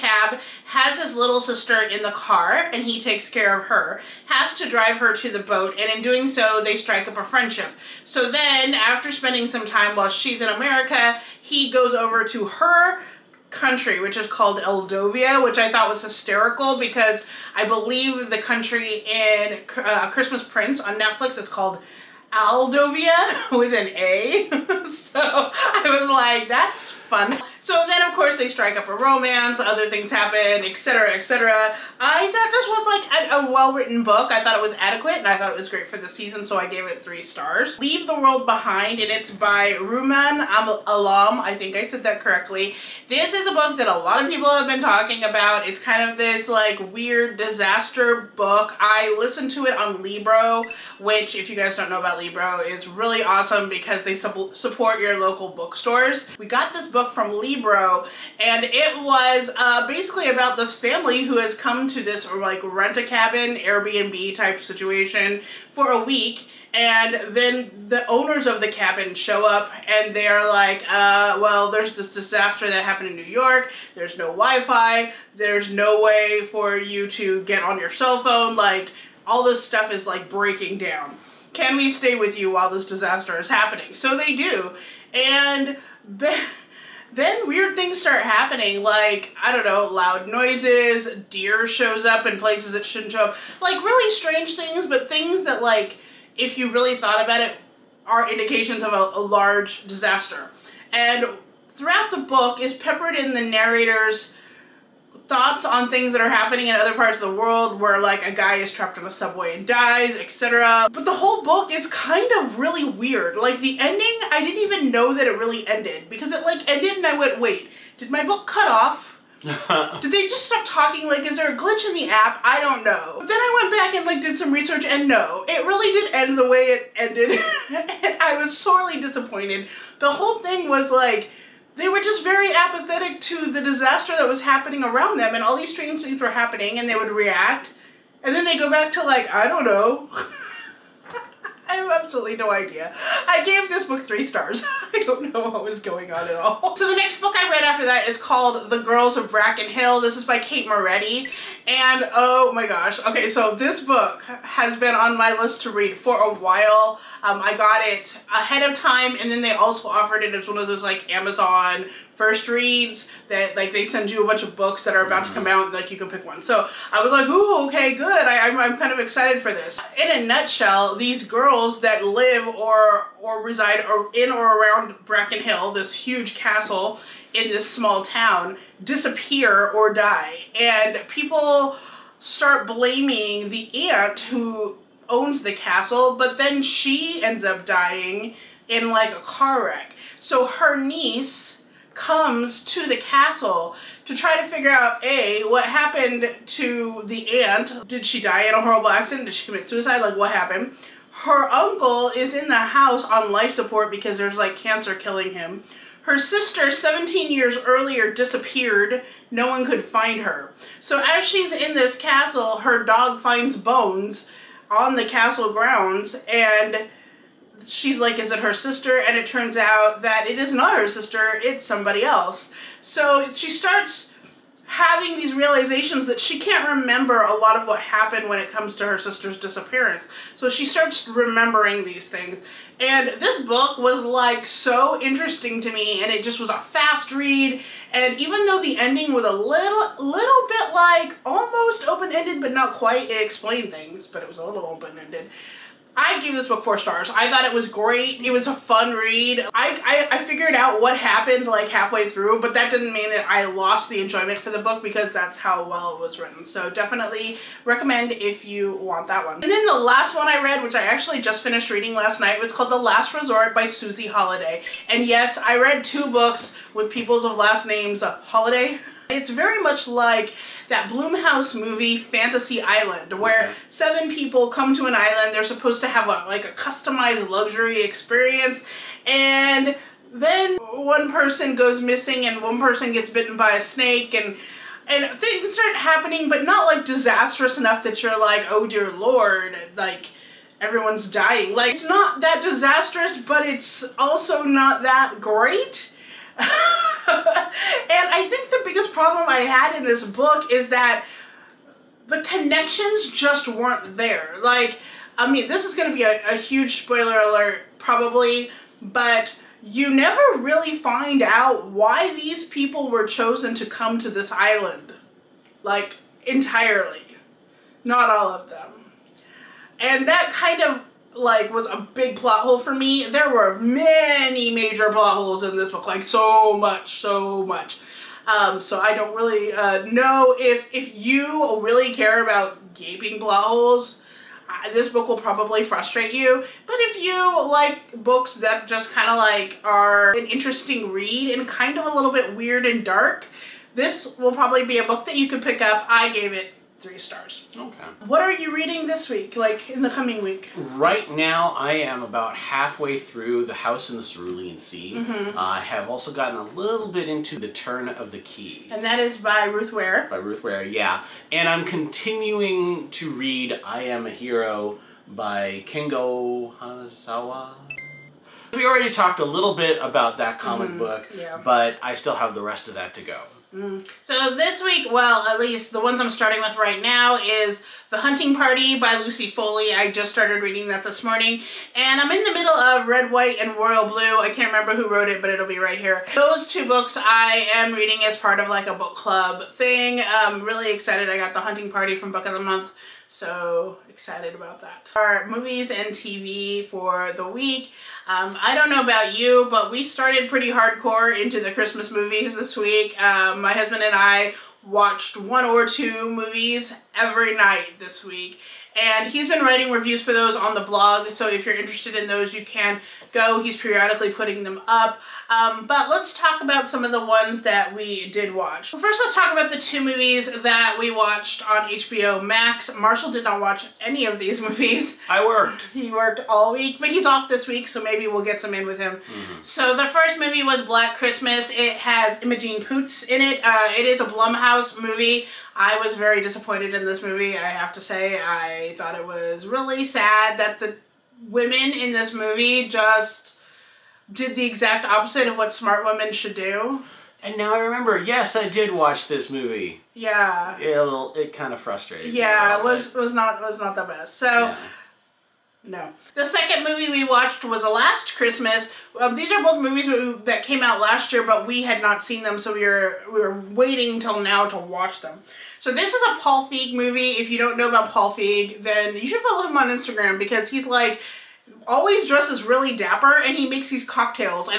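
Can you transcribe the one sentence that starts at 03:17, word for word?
Did she die in a horrible accident?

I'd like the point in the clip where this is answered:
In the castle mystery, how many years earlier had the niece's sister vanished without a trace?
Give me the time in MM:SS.
03:26.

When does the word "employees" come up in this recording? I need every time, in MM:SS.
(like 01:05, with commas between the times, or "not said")
not said.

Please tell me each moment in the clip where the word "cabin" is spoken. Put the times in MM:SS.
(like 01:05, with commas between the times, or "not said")
01:03, 01:08.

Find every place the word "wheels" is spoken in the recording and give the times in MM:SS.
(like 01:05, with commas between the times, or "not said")
not said.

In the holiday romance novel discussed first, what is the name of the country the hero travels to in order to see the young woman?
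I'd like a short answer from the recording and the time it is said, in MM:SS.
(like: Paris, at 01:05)
Eldovia, at 00:14.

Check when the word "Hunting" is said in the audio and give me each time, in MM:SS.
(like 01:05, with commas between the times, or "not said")
06:17, 06:31.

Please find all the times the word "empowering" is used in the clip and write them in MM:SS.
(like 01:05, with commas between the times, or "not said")
not said.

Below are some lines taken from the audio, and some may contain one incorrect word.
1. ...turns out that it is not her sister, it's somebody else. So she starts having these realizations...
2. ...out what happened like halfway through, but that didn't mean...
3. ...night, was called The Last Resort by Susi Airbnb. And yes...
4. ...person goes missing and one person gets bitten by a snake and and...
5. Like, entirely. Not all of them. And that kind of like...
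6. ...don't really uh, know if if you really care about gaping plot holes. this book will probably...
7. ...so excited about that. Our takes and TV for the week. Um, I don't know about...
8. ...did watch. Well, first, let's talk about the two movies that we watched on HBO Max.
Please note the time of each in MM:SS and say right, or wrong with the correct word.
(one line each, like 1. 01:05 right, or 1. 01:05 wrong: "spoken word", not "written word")
1. 03:39 right
2. 04:10 right
3. 04:22 wrong: "Holliday", not "Airbnb"
4. 04:41 right
5. 05:15 right
6. 05:28 right
7. 06:33 wrong: "movies", not "takes"
8. 06:58 right.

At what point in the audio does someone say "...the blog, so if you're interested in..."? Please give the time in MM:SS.
06:50.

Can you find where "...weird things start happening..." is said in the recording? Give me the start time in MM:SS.
01:27.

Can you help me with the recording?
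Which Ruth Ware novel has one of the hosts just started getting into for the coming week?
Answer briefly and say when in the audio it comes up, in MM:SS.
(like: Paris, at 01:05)
The Turn of the Key, at 05:57.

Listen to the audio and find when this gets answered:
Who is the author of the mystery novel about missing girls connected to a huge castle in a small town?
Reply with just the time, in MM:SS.
02:30.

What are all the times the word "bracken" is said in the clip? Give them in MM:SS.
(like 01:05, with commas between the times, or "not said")
02:29, 02:55.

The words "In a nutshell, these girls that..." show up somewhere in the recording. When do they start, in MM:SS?
02:49.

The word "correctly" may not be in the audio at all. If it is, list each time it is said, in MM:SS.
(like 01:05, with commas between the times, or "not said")
00:42.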